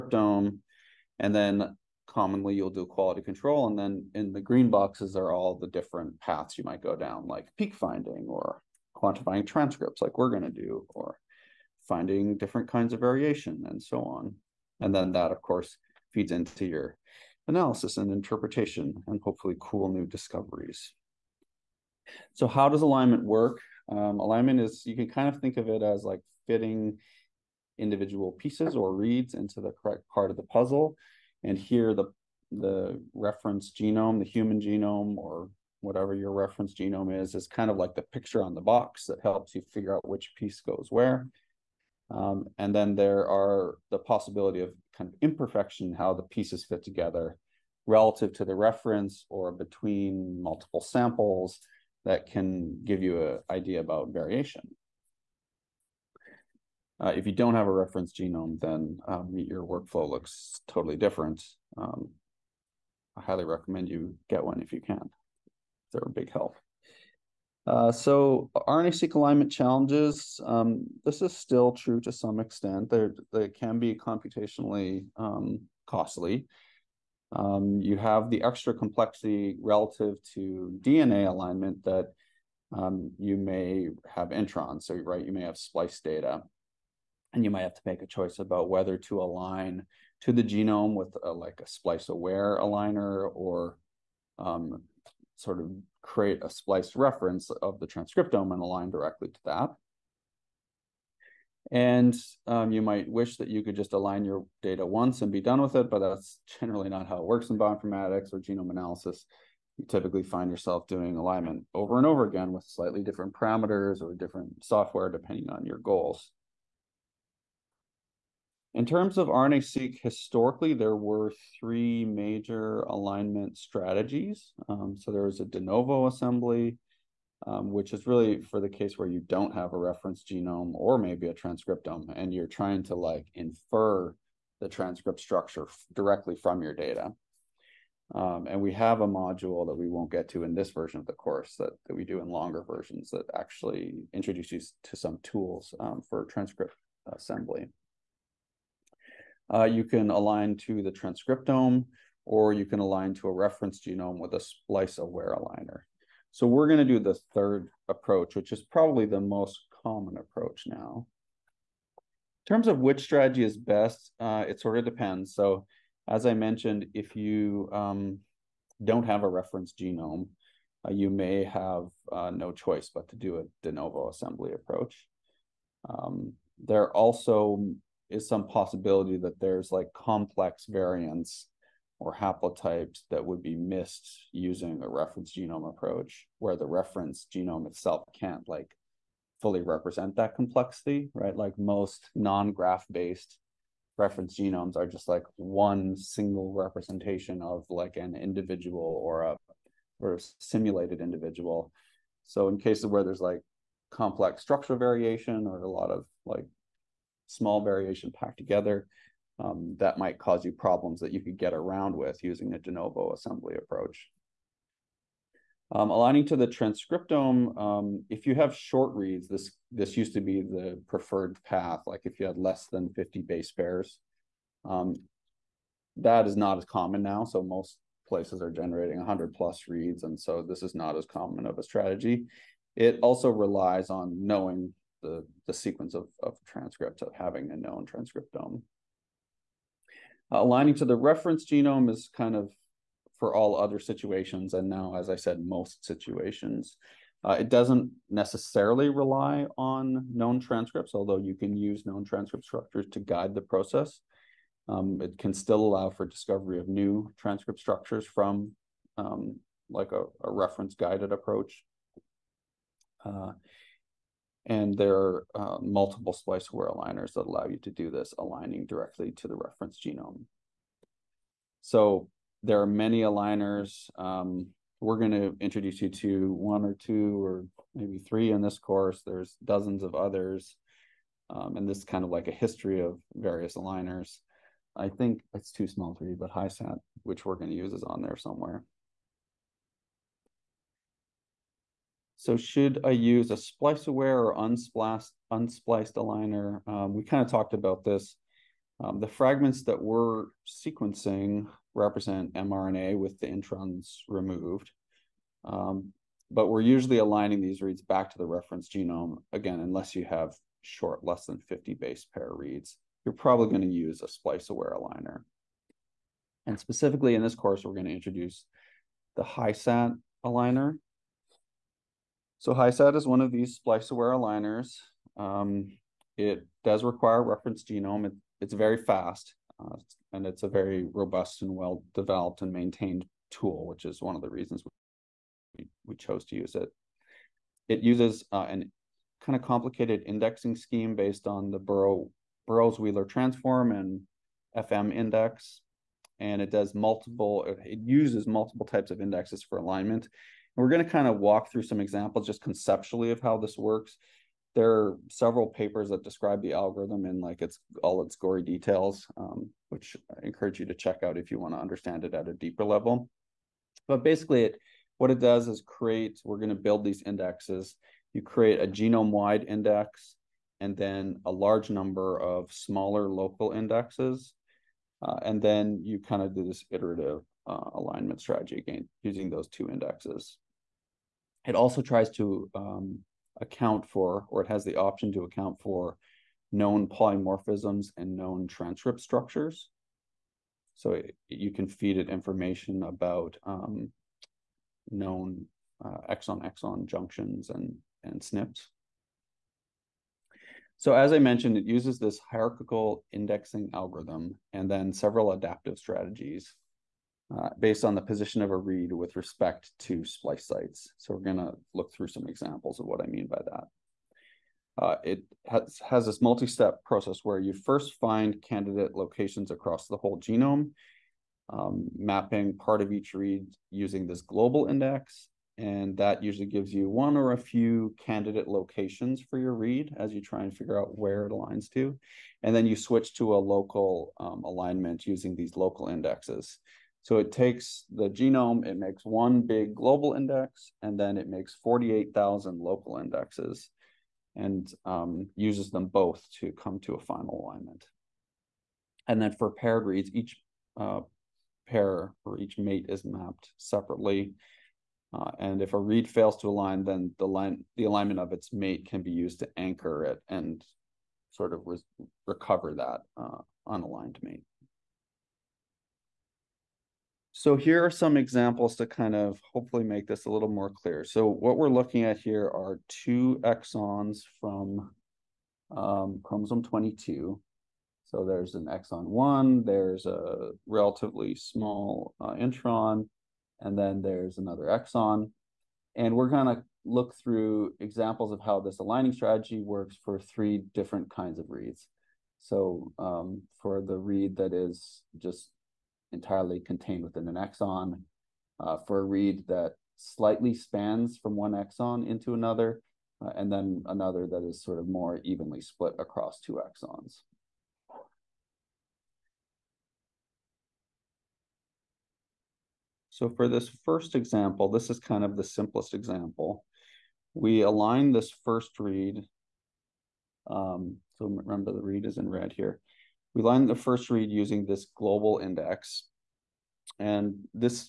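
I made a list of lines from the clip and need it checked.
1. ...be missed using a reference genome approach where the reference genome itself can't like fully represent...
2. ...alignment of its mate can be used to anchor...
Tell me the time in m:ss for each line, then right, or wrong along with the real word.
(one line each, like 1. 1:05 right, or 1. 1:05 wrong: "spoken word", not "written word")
1. 3:03 right
2. 7:37 right.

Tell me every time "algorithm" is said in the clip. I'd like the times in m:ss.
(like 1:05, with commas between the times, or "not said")
5:56, 6:43.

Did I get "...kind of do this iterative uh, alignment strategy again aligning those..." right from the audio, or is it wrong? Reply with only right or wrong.
wrong.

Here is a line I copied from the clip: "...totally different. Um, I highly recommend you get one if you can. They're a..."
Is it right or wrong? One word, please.
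right.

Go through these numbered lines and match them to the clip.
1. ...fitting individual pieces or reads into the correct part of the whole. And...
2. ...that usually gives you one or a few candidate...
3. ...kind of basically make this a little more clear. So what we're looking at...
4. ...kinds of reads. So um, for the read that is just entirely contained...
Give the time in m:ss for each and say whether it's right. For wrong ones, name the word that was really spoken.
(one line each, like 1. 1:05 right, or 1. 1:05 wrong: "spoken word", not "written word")
1. 0:26 wrong: "puzzle", not "whole"
2. 7:05 right
3. 7:48 wrong: "hopefully", not "basically"
4. 8:11 right.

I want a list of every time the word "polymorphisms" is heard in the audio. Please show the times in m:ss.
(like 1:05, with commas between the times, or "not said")
6:26.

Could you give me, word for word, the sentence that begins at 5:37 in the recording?
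It uses uh, an kind of complicated indexing scheme based on the Burrow, Burrows Wheeler transform and FM index.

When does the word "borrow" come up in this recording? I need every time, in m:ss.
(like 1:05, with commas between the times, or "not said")
not said.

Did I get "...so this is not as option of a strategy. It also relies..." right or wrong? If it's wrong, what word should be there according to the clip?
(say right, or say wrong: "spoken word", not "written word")
wrong: "common", not "option".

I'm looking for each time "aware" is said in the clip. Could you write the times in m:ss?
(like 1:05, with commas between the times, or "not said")
1:32, 2:34, 4:26, 4:53, 5:14, 5:23.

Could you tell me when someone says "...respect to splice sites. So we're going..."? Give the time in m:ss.
6:49.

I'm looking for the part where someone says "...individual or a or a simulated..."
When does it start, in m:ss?
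3:18.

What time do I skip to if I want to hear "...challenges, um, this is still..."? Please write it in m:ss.
1:09.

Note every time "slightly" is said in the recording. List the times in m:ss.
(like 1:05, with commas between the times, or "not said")
1:52, 8:19.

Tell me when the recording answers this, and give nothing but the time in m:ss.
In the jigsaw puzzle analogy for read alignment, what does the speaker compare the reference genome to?
0:37.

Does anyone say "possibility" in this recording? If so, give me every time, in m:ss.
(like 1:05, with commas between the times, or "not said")
0:43, 2:58.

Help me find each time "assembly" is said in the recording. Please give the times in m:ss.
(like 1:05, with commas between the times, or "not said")
2:06, 2:27, 2:54, 3:33.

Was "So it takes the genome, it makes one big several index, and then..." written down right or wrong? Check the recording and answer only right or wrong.
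wrong.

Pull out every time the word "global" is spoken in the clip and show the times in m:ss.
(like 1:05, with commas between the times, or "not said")
7:04, 7:19, 8:44.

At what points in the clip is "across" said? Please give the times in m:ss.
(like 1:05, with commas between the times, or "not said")
6:59, 8:26.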